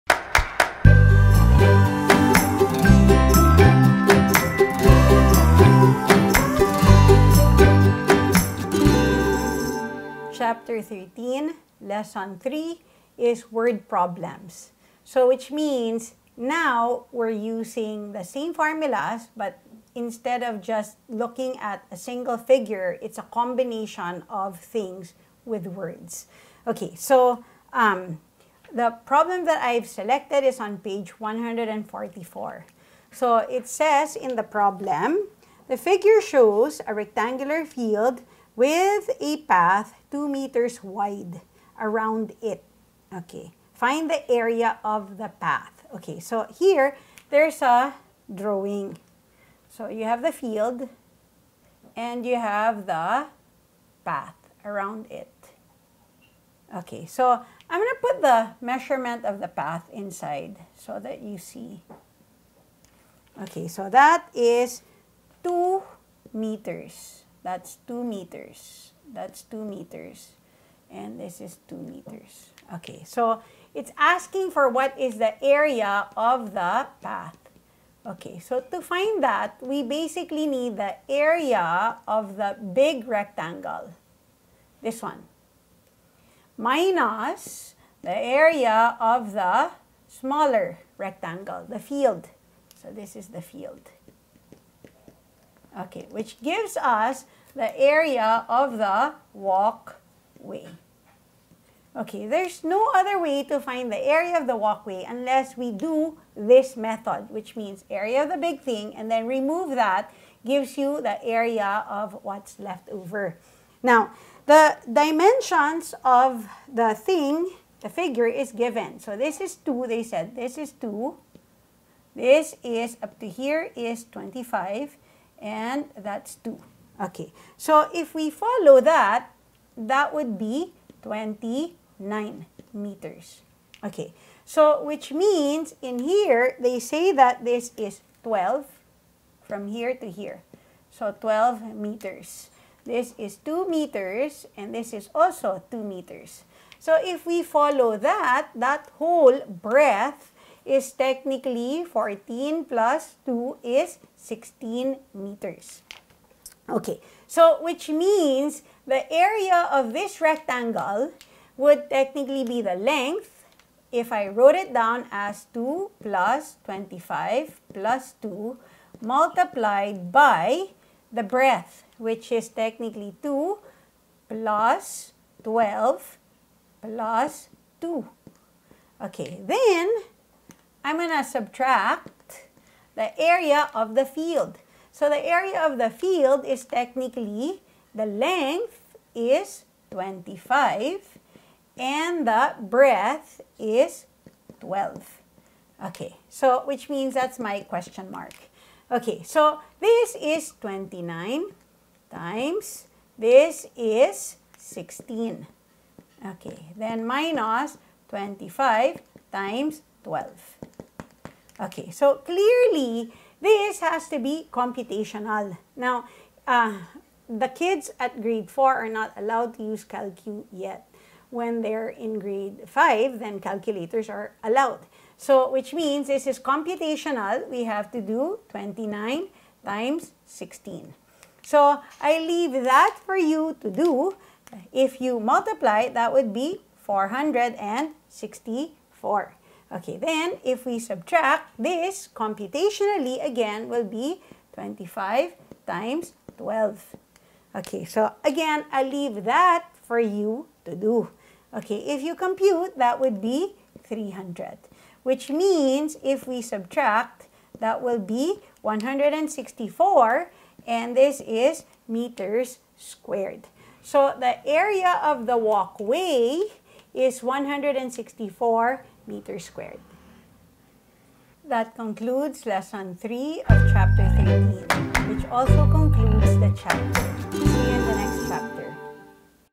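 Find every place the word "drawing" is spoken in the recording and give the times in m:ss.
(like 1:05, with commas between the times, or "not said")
0:48.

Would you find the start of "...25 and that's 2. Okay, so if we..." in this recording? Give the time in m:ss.
2:04.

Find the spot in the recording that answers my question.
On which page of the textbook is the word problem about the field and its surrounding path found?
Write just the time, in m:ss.
0:31.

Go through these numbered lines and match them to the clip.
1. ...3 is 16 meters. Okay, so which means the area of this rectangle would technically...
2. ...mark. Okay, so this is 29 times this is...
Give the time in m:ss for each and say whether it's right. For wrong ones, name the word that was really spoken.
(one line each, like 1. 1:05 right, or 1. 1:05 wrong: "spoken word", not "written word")
1. 2:33 wrong: "2", not "3"
2. 3:18 right.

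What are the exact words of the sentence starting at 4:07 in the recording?
Okay, so again, i leave that for you to do.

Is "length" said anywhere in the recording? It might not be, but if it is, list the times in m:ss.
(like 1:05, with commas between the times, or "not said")
2:42, 3:08.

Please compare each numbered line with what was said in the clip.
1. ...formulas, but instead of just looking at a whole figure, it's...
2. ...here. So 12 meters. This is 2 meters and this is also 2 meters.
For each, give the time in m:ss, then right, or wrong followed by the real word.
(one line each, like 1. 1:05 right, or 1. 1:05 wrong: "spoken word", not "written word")
1. 0:18 wrong: "single", not "whole"
2. 2:20 right.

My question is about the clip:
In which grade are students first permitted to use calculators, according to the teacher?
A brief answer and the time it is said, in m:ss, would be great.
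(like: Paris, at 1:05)
Grade 5, at 3:42.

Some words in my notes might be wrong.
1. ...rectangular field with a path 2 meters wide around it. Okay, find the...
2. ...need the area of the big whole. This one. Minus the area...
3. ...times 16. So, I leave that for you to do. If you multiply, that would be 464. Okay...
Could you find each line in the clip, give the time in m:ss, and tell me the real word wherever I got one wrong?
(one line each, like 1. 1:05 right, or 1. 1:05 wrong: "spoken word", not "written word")
1. 0:36 right
2. 1:20 wrong: "rectangle", not "whole"
3. 3:49 right.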